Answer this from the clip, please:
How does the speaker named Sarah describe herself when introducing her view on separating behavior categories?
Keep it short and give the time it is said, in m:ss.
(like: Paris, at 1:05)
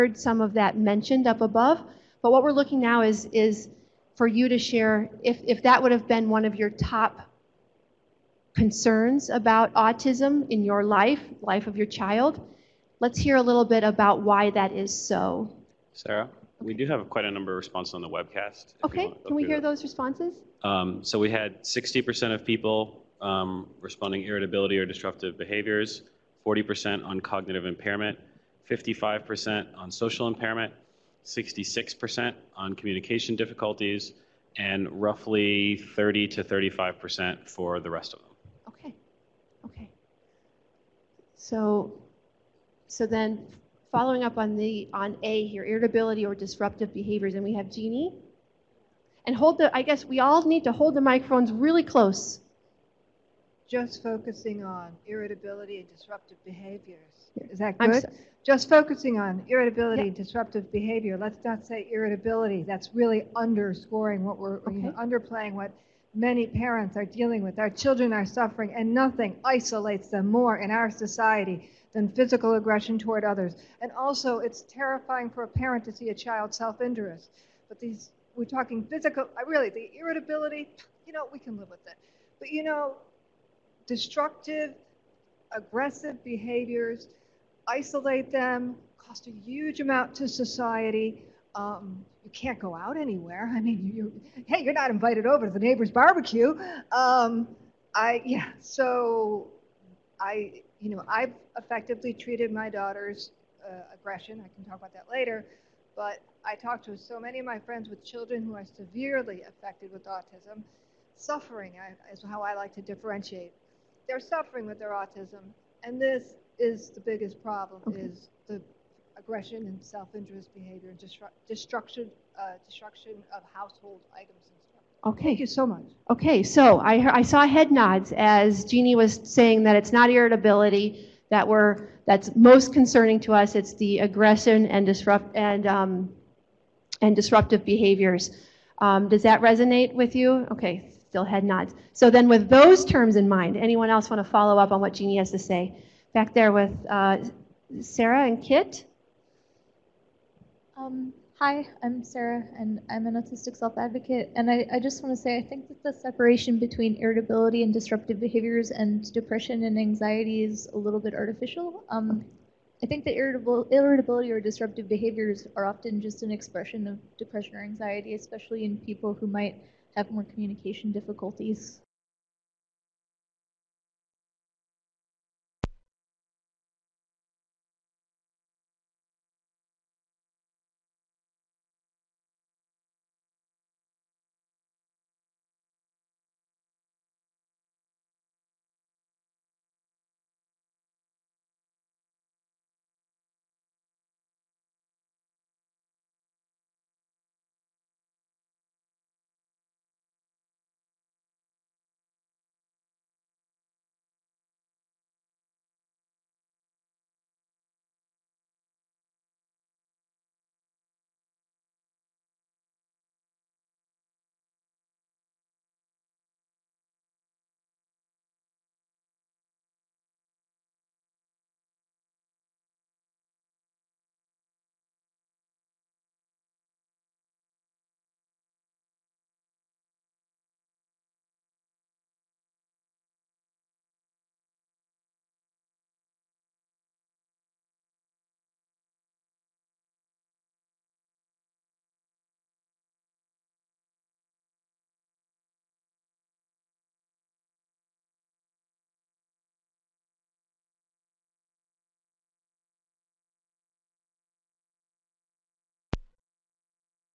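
autistic self advocate, at 2:33.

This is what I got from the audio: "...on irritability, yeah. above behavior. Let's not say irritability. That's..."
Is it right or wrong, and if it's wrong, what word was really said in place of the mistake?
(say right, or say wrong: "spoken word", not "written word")
wrong: "disruptive", not "above".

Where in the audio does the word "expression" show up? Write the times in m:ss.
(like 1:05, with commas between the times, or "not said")
2:46.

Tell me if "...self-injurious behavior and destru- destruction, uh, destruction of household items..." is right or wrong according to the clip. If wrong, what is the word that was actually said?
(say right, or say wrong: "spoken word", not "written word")
right.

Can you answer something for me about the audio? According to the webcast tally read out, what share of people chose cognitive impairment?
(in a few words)
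40%.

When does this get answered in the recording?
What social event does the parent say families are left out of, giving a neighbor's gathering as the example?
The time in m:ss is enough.
1:35.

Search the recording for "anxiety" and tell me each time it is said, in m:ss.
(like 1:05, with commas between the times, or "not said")
2:39, 2:47.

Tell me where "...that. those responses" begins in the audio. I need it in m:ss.
0:19.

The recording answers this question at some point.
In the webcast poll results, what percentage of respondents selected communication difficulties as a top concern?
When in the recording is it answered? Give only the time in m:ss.
0:31.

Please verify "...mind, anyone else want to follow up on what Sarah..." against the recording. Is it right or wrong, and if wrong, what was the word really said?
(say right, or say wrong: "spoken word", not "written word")
wrong: "Jeannie", not "Sarah".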